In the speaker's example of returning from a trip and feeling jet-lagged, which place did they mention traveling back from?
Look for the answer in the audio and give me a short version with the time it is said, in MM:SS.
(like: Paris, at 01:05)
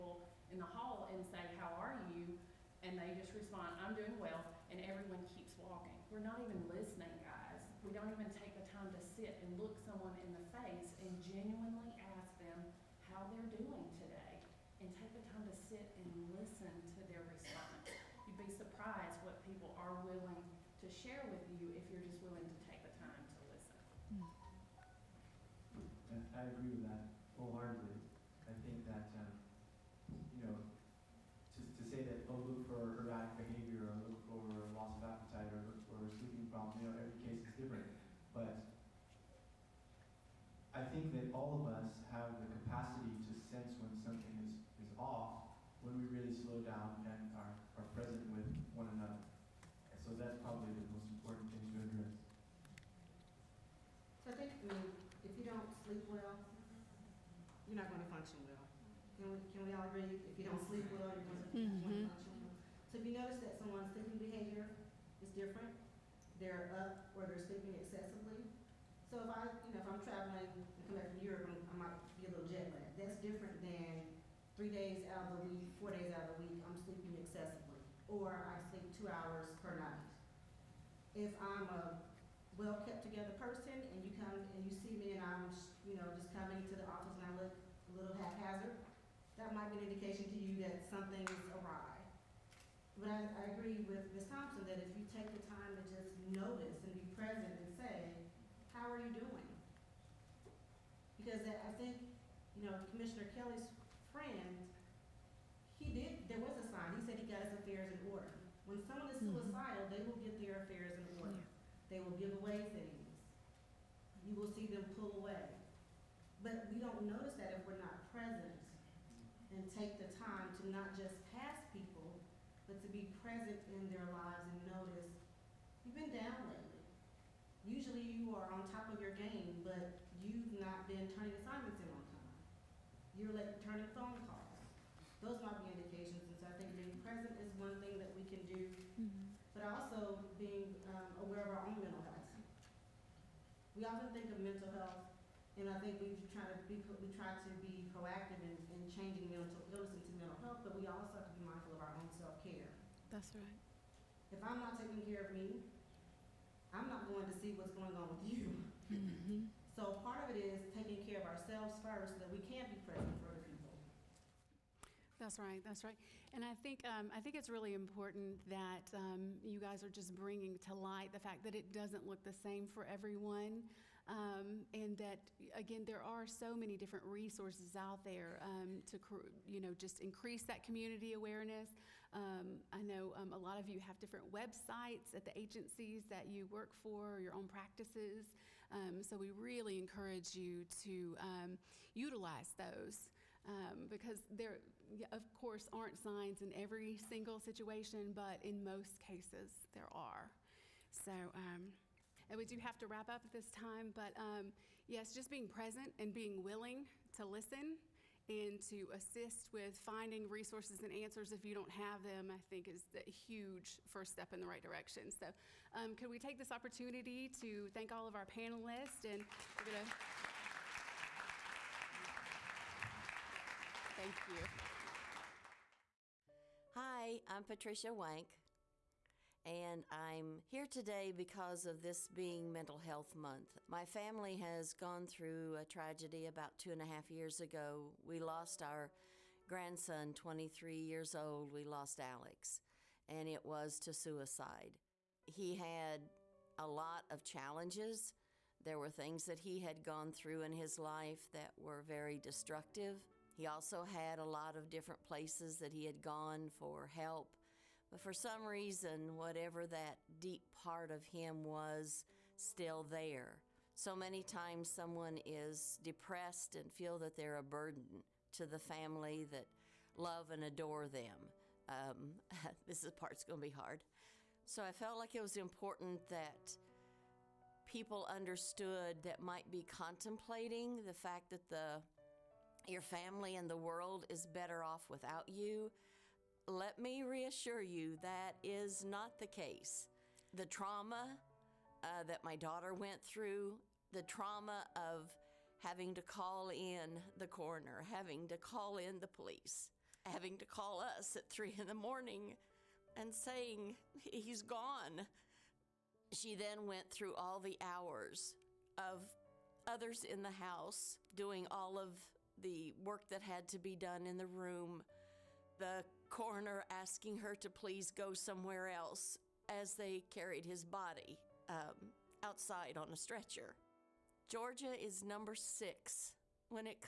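Europe, at 01:11.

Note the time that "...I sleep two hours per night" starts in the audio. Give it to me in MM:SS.
01:18.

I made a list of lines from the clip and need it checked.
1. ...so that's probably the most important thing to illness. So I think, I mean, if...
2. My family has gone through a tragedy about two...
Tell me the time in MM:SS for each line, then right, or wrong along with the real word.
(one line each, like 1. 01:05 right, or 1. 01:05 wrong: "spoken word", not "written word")
1. 00:49 wrong: "address", not "illness"
2. 03:53 right.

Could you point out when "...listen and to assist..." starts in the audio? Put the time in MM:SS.
03:27.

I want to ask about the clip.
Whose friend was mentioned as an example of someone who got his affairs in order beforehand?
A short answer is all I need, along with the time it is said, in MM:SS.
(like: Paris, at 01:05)
Commissioner Kelly, at 01:42.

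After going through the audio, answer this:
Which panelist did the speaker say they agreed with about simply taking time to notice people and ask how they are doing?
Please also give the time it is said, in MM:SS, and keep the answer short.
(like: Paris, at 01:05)
Ms. Thompson, at 01:34.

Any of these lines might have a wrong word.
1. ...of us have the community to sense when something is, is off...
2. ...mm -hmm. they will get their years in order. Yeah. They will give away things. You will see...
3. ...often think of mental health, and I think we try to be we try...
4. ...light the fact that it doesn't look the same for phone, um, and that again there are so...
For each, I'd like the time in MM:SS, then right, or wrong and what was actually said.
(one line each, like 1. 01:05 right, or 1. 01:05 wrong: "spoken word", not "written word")
1. 00:41 wrong: "capacity", not "community"
2. 01:49 wrong: "affairs", not "years"
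3. 02:23 right
4. 02:50 wrong: "everyone", not "phone".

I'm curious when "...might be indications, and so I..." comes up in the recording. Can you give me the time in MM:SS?
02:15.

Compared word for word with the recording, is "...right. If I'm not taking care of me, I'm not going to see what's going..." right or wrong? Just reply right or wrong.
right.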